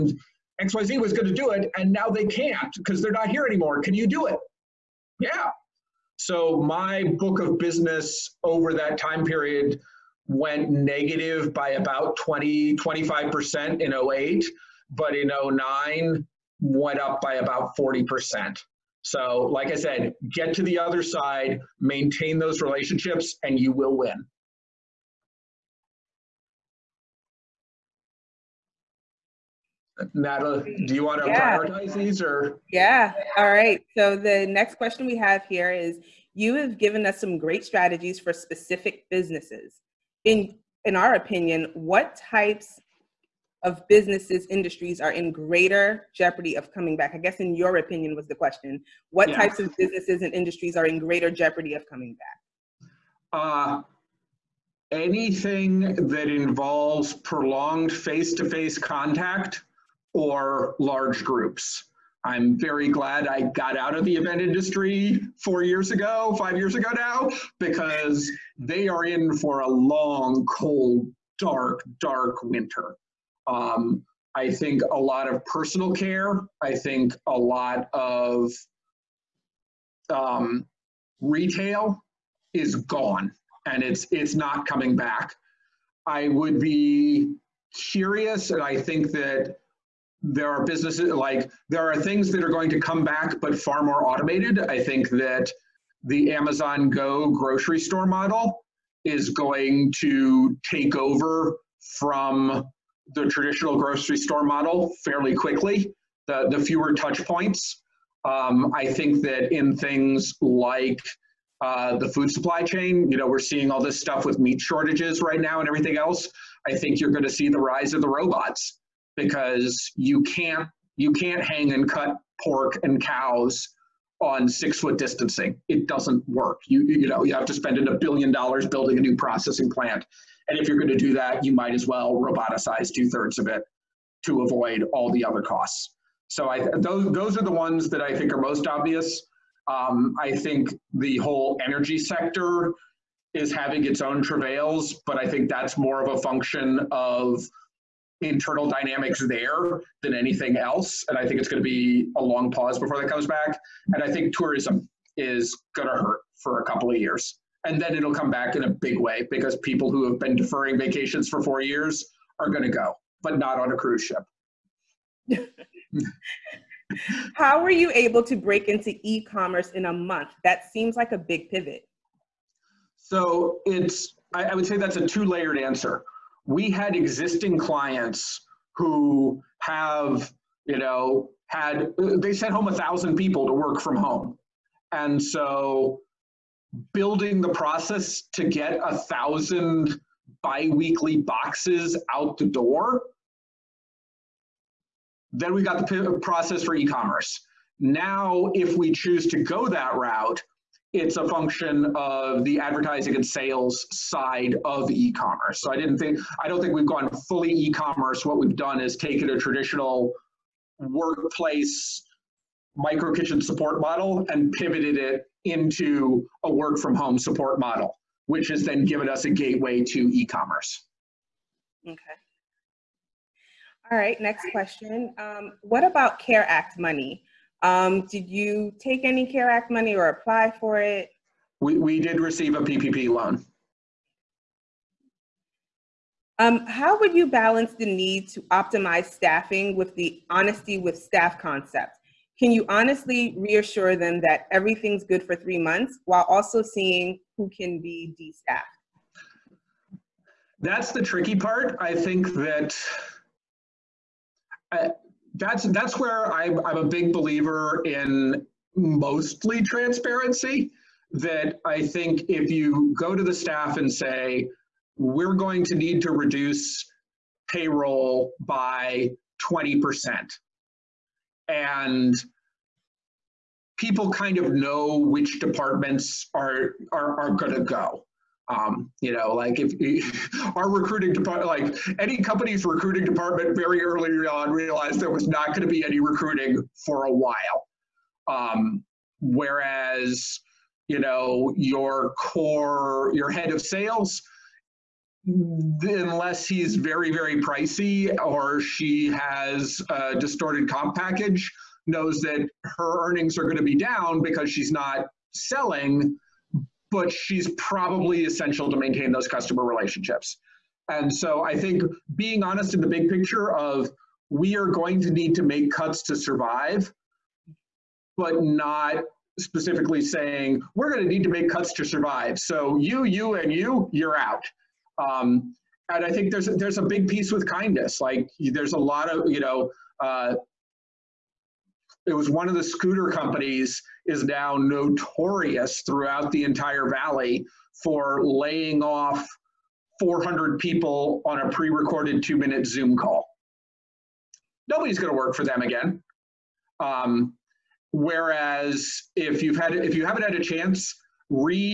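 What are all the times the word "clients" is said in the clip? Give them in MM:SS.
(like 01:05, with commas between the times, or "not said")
02:57.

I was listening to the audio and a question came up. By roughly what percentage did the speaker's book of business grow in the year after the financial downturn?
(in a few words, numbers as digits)
40%.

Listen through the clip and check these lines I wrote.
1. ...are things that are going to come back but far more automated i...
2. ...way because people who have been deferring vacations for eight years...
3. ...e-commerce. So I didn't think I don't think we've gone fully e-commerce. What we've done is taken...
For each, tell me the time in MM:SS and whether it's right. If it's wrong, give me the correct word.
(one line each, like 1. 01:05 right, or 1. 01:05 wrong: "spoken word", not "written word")
1. 01:31 right
2. 02:38 wrong: "four", not "eight"
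3. 03:24 right.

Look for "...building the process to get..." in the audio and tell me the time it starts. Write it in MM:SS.
03:06.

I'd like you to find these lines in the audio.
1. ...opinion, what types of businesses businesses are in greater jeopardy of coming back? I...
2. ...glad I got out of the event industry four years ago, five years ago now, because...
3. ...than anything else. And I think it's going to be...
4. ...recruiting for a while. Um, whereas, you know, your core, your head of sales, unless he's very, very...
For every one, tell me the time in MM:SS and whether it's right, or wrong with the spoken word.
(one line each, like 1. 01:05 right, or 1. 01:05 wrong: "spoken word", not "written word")
1. 00:41 wrong: "industries", not "businesses"
2. 01:02 right
3. 02:30 right
4. 04:45 right.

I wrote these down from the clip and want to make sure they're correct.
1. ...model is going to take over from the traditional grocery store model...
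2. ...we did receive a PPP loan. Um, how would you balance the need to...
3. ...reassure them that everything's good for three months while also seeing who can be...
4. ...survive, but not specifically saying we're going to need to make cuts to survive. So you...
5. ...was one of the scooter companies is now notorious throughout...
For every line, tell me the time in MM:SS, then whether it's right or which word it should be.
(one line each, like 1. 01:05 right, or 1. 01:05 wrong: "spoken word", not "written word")
1. 01:38 right
2. 03:51 right
3. 04:03 right
4. 05:16 right
5. 05:32 right.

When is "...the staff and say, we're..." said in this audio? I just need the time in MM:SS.
04:23.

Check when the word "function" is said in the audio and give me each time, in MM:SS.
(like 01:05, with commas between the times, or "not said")
02:26, 03:21.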